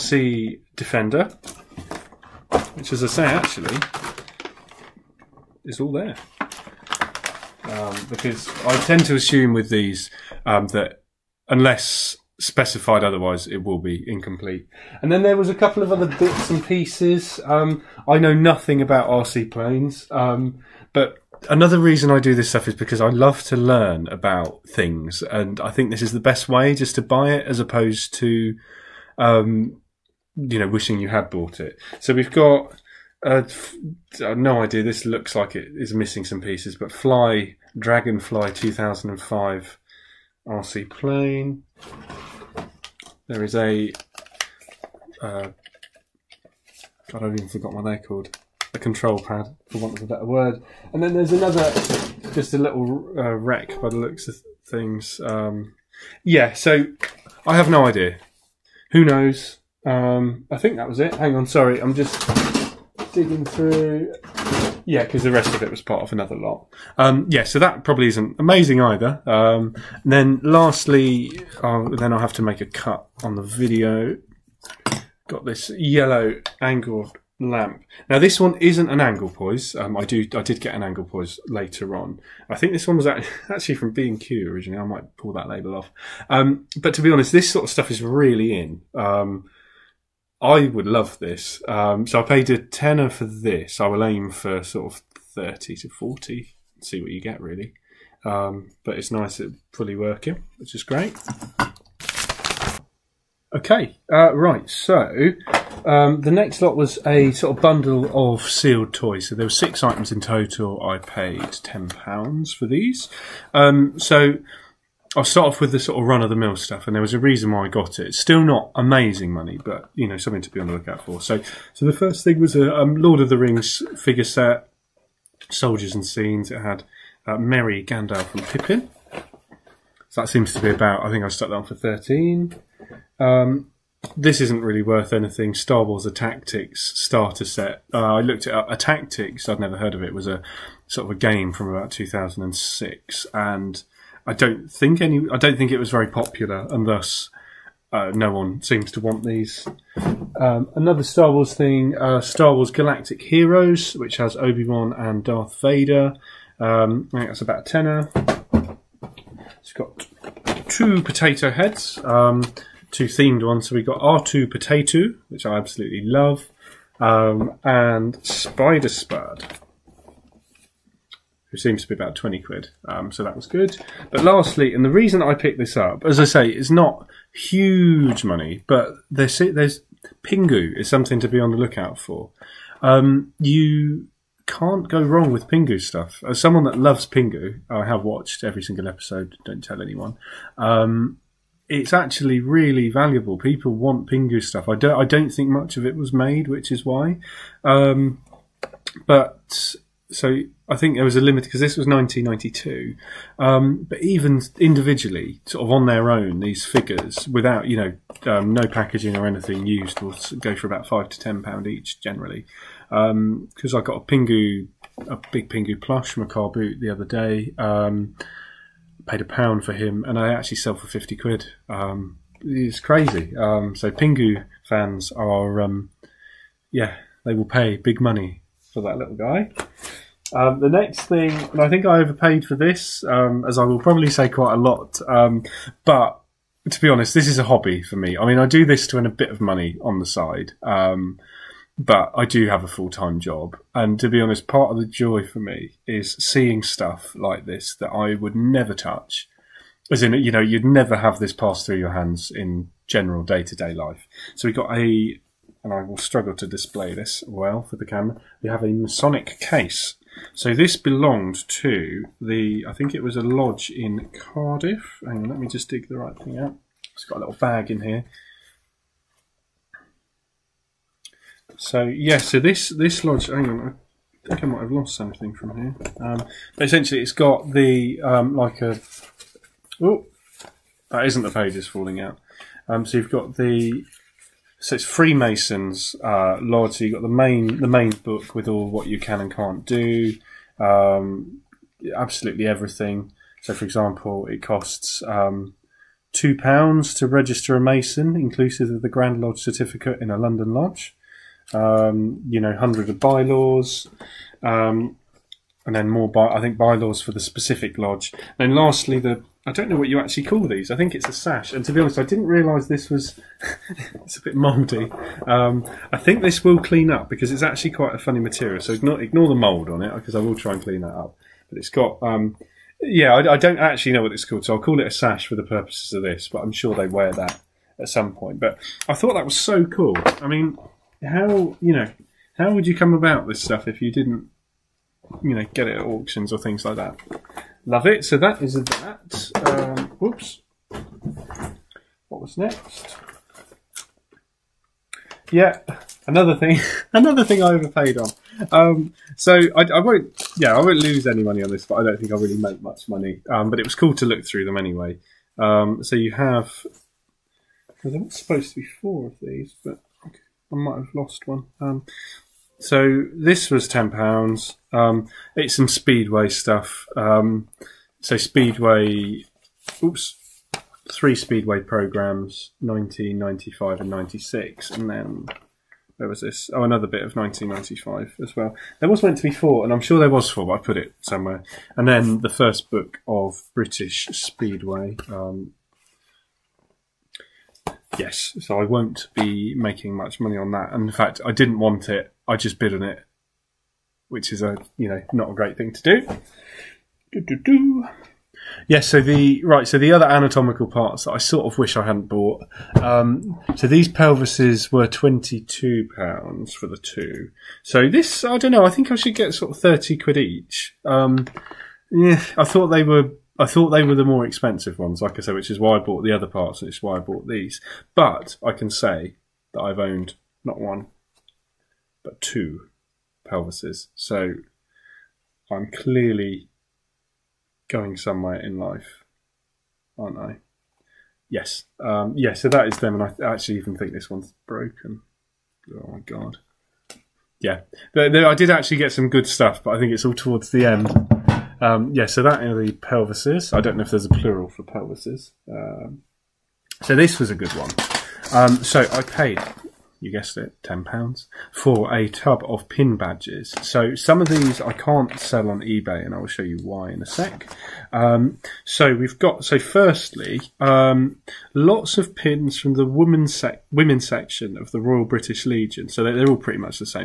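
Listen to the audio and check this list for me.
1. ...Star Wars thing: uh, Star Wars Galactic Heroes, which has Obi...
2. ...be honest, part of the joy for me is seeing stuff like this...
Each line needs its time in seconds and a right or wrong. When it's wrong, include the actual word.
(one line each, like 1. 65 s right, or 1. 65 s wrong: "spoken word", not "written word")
1. 151 s right
2. 244 s right.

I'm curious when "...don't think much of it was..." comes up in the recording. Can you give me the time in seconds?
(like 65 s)
195 s.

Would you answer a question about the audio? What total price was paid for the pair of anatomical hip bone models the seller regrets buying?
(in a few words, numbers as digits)
£22.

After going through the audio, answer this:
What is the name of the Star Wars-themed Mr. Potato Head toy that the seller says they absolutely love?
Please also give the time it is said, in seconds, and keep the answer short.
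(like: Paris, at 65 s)
R2 Potato, at 163 s.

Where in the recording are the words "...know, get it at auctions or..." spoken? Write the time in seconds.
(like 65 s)
335 s.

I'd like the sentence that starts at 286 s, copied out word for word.
So you got the main the main book with all what you can and can't do, um, absolutely everything.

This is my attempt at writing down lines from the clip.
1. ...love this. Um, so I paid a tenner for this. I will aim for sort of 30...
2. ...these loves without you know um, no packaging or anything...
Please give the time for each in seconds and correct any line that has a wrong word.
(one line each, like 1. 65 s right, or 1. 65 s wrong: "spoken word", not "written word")
1. 90 s right
2. 206 s wrong: "figures", not "loves".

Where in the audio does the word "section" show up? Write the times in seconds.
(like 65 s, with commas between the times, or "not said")
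464 s.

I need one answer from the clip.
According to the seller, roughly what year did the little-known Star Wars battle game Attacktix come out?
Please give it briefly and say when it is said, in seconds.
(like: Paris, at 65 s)
2006, at 141 s.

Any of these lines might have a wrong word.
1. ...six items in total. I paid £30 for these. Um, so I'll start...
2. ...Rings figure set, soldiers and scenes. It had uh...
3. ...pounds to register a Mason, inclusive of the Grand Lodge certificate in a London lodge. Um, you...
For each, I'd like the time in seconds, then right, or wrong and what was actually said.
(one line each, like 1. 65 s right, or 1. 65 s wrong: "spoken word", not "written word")
1. 109 s wrong: "10", not "30"
2. 123 s right
3. 296 s right.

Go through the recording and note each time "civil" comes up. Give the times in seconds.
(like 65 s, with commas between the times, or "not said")
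not said.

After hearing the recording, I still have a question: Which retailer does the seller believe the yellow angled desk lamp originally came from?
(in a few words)
B and Q.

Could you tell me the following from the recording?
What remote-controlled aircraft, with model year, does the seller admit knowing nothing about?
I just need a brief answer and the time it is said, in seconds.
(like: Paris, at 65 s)
Fly Dragonfly 2005, at 36 s.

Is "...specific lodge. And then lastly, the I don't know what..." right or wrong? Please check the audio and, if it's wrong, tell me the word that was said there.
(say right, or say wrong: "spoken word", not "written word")
right.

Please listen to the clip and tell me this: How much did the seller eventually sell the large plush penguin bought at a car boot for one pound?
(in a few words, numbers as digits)
£50.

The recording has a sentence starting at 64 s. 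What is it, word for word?
Yeah, because the rest of it was part of another lot.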